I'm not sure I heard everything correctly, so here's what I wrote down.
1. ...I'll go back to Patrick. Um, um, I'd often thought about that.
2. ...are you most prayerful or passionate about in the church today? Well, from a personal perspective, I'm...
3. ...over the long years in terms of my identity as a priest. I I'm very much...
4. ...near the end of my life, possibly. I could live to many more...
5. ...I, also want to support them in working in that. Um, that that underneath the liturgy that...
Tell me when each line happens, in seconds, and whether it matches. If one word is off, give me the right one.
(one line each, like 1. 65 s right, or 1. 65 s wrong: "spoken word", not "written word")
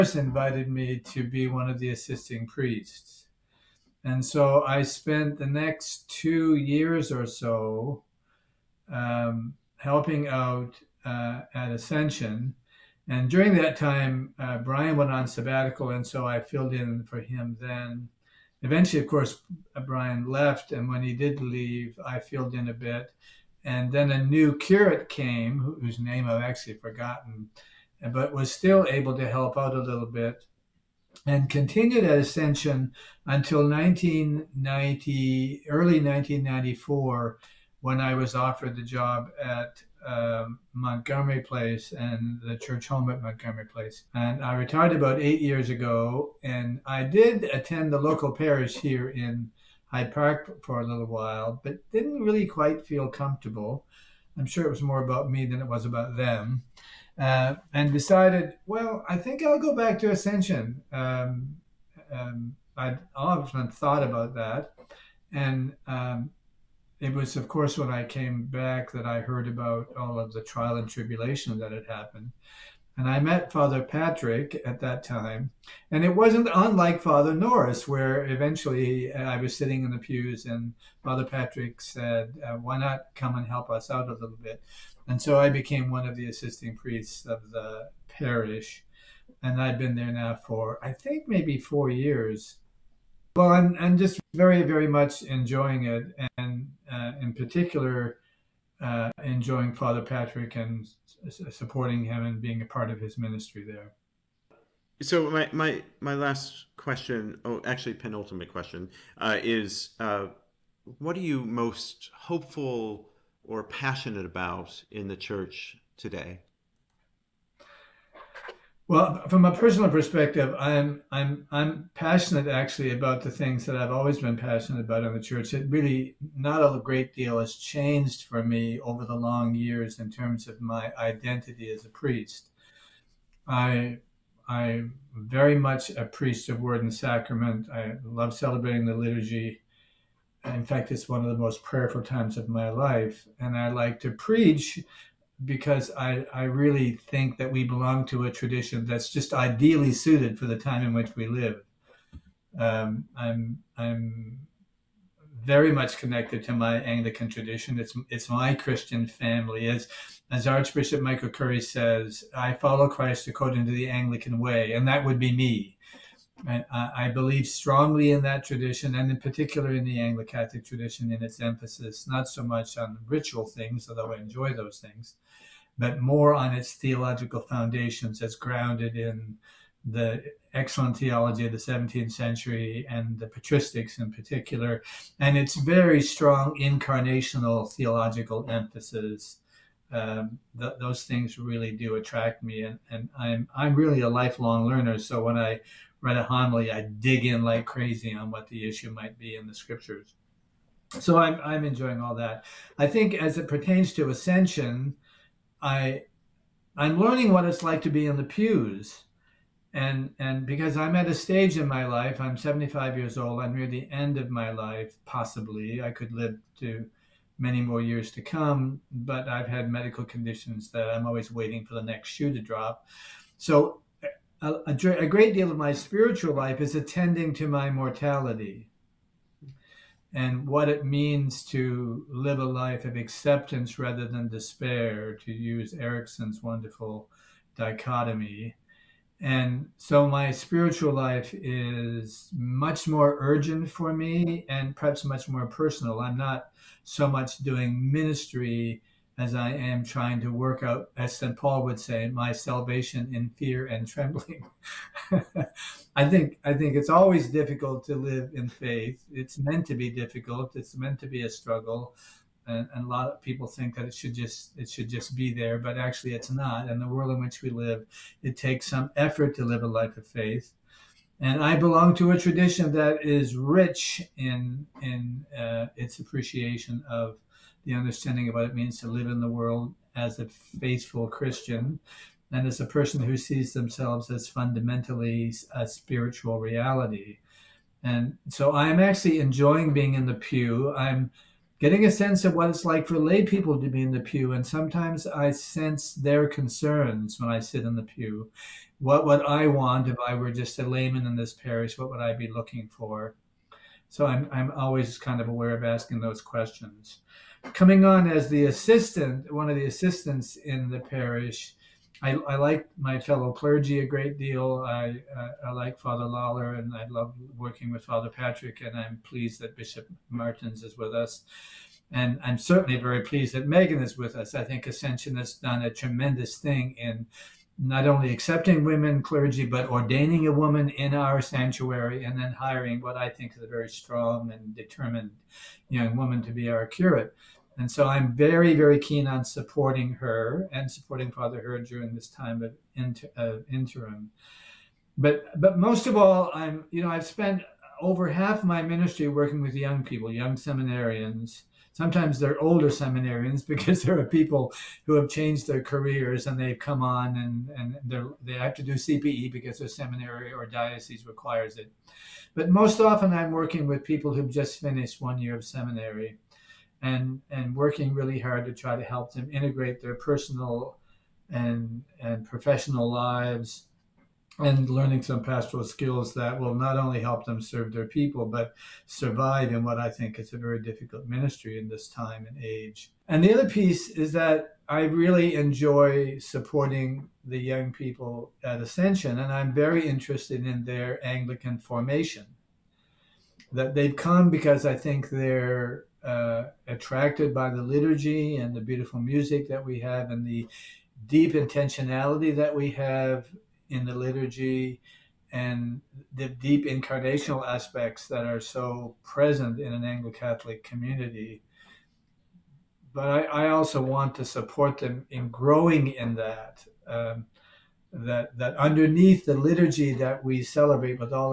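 1. 59 s wrong: "Ascension", not "Patrick"
2. 111 s wrong: "hopeful", not "prayerful"
3. 128 s right
4. 213 s right
5. 413 s wrong: "growing", not "working".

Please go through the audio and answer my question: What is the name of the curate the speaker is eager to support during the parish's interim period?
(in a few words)
Megan.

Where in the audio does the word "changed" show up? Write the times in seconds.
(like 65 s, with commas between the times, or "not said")
127 s, 355 s.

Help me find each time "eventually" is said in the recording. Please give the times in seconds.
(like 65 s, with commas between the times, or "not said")
18 s, 78 s.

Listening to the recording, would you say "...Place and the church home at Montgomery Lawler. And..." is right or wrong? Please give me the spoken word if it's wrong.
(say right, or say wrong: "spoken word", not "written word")
wrong: "Place", not "Lawler".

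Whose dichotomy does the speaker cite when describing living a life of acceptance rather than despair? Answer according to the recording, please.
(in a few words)
Erikson.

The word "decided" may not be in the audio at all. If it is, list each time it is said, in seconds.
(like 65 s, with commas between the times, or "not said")
57 s.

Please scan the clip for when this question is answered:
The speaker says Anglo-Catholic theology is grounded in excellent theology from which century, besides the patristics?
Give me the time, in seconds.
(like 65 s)
181 s.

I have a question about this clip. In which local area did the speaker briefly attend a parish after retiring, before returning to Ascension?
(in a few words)
Hyde Park.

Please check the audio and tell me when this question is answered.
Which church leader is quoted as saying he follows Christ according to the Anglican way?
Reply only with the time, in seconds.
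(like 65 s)
161 s.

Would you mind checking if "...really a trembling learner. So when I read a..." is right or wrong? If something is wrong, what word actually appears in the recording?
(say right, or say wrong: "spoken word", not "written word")
wrong: "lifelong", not "trembling".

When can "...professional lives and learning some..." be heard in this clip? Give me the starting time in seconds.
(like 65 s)
372 s.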